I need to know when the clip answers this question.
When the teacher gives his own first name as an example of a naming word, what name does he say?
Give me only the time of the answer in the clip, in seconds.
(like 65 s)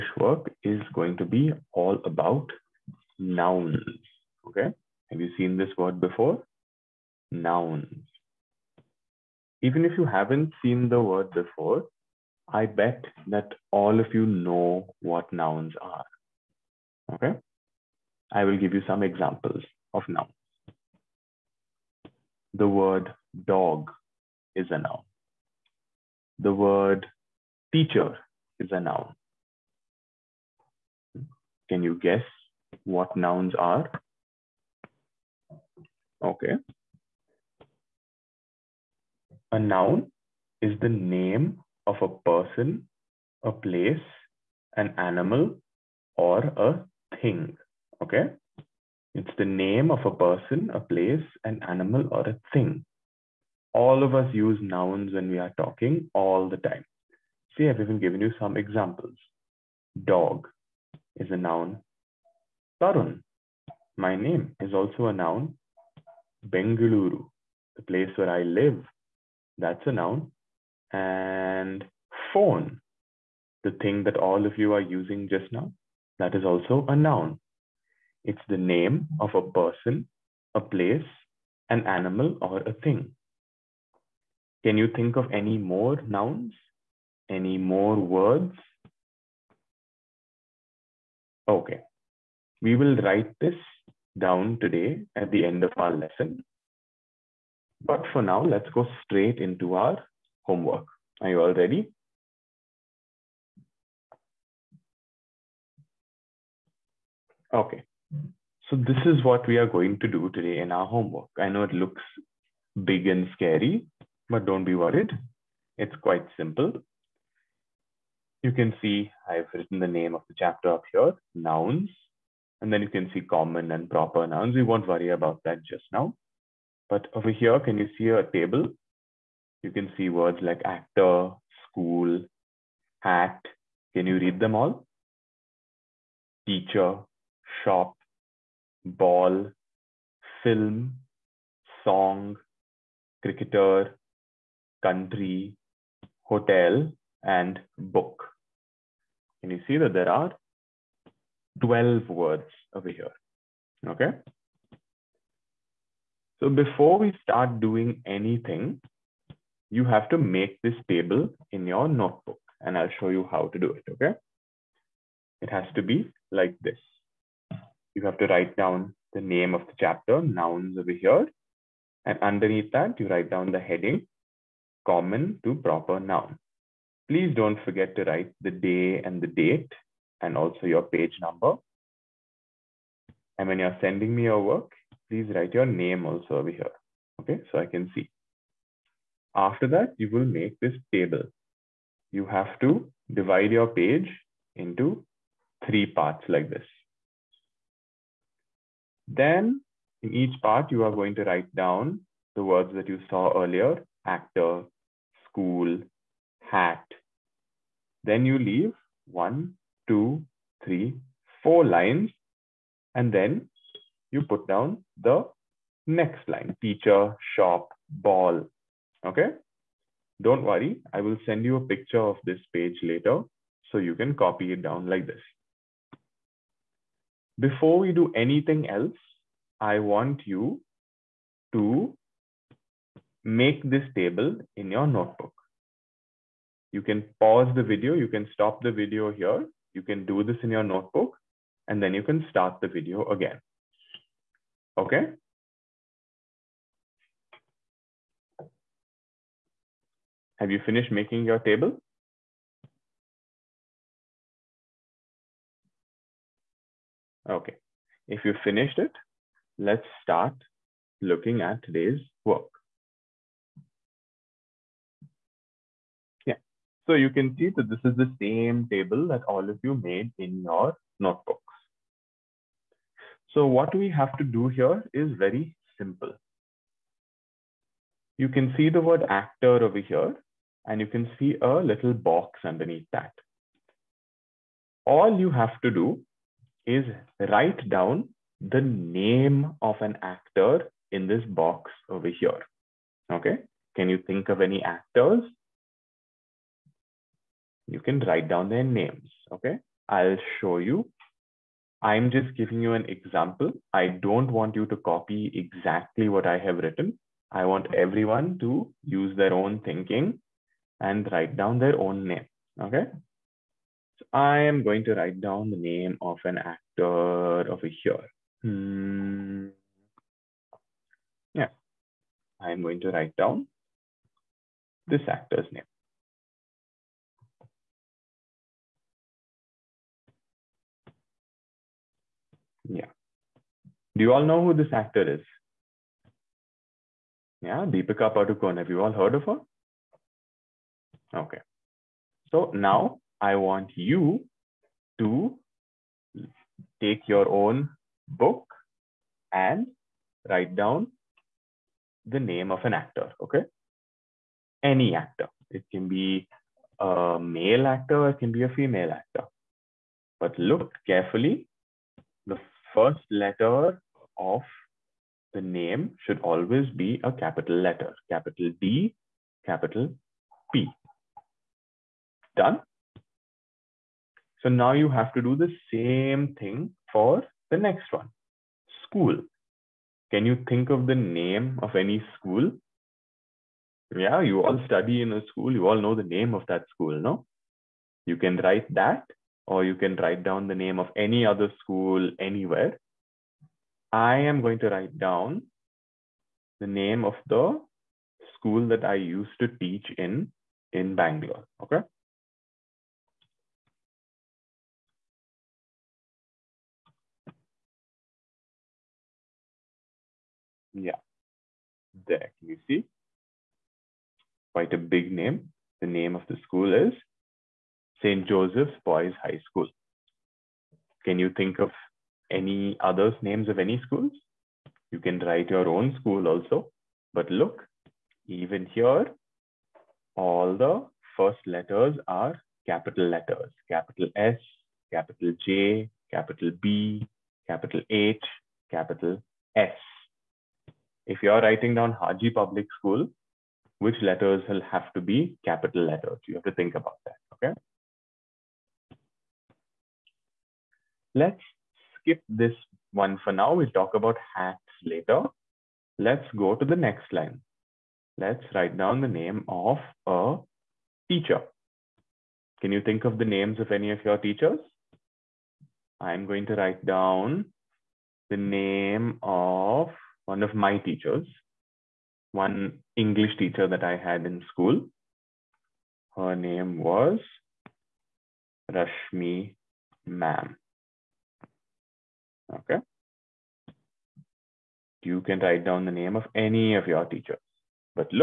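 62 s.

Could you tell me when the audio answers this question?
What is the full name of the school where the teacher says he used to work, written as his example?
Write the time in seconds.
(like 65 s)
418 s.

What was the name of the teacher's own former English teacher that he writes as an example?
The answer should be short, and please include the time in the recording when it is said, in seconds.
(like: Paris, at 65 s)
Rashmi Ma'am, at 478 s.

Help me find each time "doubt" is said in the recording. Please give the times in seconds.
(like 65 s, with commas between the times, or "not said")
not said.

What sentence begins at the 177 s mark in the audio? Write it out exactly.
Please don't forget to write the day and the date and also your page number.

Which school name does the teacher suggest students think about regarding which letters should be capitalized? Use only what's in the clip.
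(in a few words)
Haji Public School.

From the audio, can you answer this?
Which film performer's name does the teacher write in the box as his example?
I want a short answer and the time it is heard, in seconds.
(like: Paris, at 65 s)
Deepika Padukone, at 337 s.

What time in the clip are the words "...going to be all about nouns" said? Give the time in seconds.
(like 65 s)
0 s.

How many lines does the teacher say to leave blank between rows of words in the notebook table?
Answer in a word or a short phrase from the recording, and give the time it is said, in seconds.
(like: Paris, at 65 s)
4, at 211 s.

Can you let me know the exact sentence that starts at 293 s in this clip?
Okay, can you think of any actors?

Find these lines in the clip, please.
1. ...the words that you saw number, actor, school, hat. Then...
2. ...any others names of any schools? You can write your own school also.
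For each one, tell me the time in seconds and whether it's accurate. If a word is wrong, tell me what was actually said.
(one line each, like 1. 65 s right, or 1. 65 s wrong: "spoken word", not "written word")
1. 202 s wrong: "earlier", not "number"
2. 422 s right.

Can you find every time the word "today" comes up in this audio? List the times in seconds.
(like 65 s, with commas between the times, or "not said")
94 s, 110 s, 261 s.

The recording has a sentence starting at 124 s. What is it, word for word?
We won't worry about that just now.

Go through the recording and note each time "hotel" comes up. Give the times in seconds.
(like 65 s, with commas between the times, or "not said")
146 s.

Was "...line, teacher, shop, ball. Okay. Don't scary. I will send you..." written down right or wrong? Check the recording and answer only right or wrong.
wrong.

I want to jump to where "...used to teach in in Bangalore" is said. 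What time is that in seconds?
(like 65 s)
398 s.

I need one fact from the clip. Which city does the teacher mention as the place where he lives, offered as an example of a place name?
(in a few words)
Bengaluru.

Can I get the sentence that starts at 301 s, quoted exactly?
I'm just giving you an example.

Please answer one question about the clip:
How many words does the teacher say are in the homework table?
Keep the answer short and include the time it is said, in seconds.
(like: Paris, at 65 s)
12, at 151 s.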